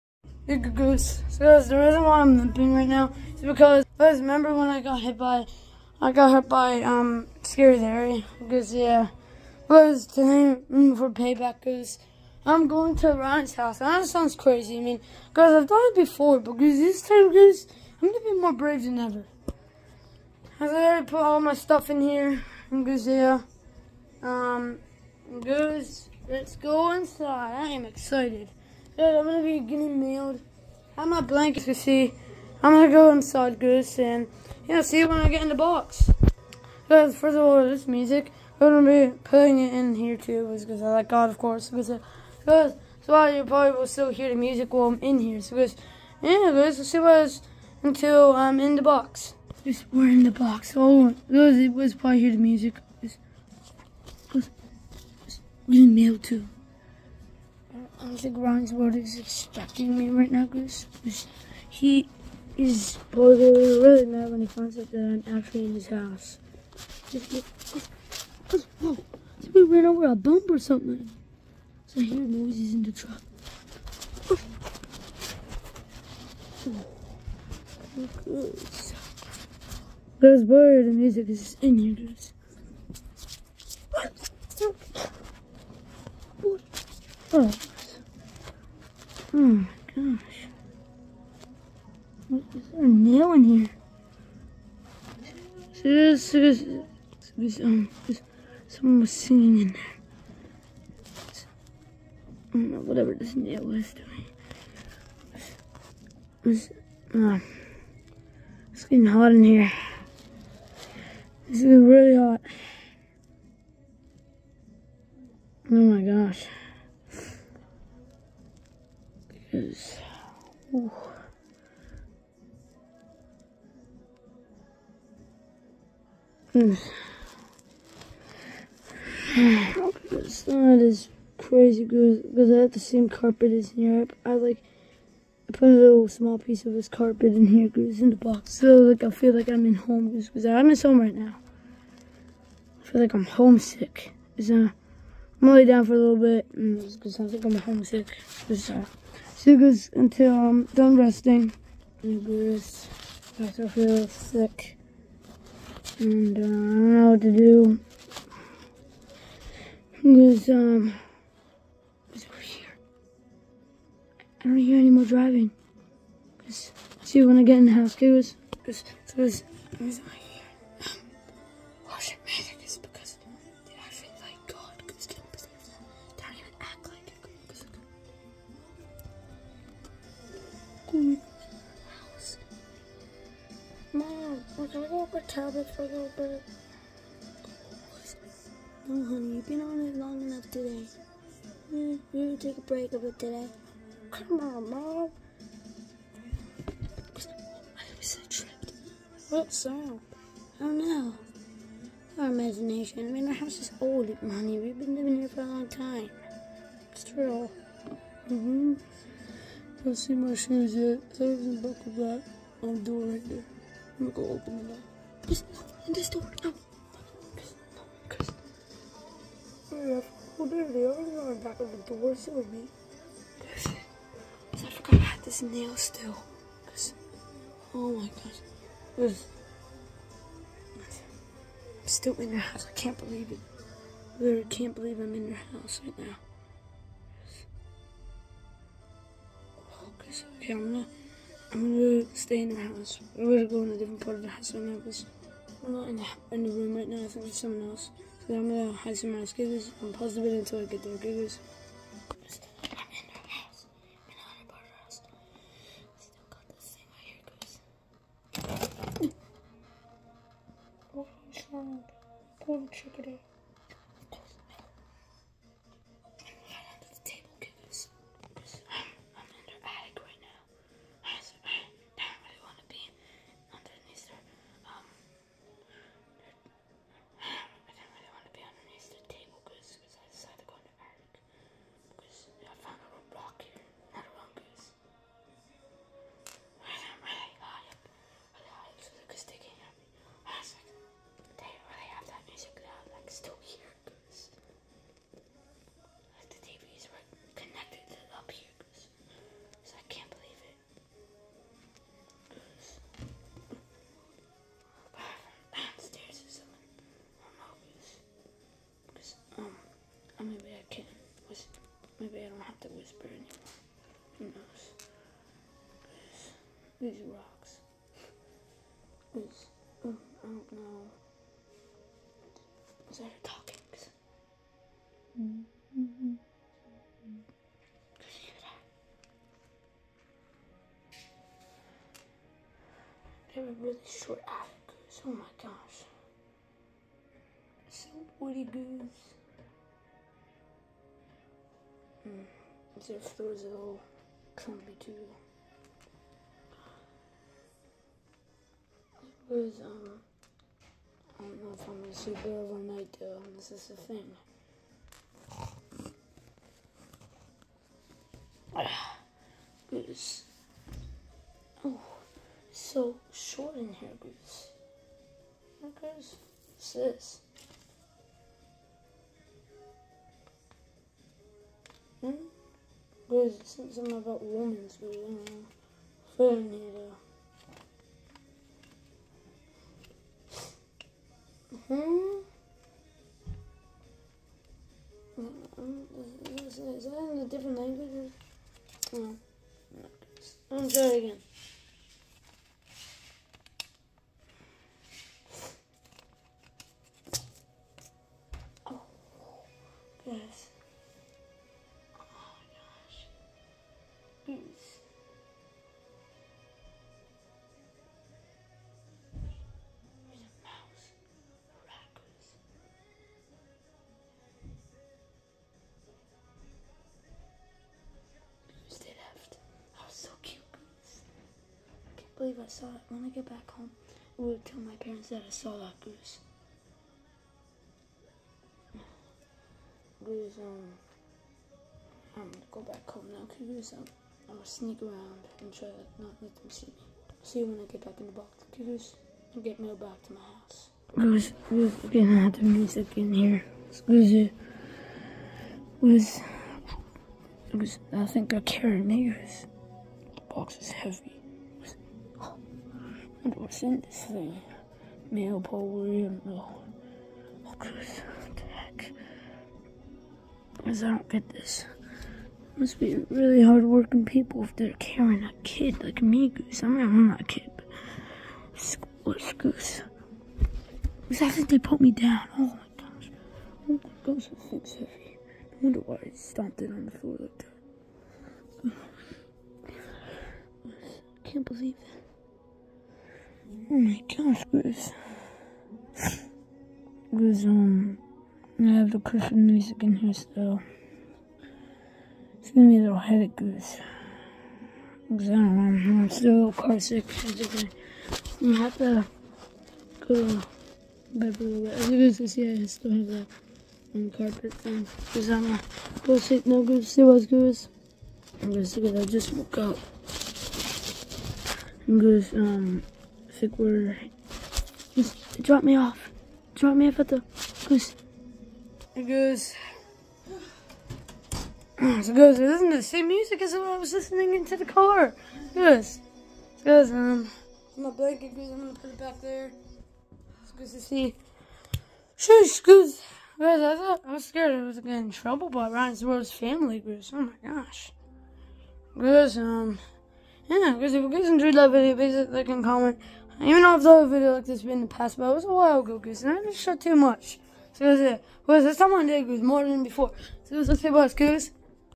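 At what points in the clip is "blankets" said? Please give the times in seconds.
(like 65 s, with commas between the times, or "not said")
31 s, 527 s.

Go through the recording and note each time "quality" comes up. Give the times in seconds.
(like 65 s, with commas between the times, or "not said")
not said.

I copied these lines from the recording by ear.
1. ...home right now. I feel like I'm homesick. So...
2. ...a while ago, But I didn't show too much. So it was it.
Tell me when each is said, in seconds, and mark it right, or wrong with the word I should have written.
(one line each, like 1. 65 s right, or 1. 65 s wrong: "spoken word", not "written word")
1. 140 s right
2. 545 s wrong: "And", not "But".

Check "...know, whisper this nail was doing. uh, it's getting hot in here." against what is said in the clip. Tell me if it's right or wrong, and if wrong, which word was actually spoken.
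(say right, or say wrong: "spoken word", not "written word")
wrong: "whatever", not "whisper".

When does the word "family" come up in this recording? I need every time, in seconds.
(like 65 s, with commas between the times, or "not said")
536 s.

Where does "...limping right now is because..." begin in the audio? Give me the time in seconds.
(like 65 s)
2 s.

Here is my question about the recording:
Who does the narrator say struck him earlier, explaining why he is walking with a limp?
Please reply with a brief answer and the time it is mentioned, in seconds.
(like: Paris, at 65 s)
Scary Larry, at 7 s.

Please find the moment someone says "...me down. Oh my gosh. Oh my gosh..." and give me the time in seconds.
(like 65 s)
471 s.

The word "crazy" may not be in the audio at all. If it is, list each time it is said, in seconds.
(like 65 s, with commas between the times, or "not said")
14 s, 131 s.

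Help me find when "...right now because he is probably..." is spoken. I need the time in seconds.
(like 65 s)
60 s.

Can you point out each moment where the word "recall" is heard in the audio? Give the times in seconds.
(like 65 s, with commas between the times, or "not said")
not said.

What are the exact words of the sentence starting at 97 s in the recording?
Um, someone was singing in there.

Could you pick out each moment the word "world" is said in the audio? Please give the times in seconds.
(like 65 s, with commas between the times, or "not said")
58 s, 536 s.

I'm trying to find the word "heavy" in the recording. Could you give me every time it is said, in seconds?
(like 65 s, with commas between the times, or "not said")
450 s, 474 s.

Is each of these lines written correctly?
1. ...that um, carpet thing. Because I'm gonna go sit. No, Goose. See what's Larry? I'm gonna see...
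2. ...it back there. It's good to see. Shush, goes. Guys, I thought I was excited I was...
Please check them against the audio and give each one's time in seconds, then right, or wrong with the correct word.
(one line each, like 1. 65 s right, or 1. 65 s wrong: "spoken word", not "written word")
1. 503 s wrong: "Goose", not "Larry"
2. 528 s wrong: "scared", not "excited".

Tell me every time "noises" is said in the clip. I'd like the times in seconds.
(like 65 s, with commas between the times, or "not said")
72 s.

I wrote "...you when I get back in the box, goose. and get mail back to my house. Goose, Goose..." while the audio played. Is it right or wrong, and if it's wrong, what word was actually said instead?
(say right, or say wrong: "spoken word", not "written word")
right.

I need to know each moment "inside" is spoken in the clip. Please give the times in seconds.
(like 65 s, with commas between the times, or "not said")
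26 s, 33 s.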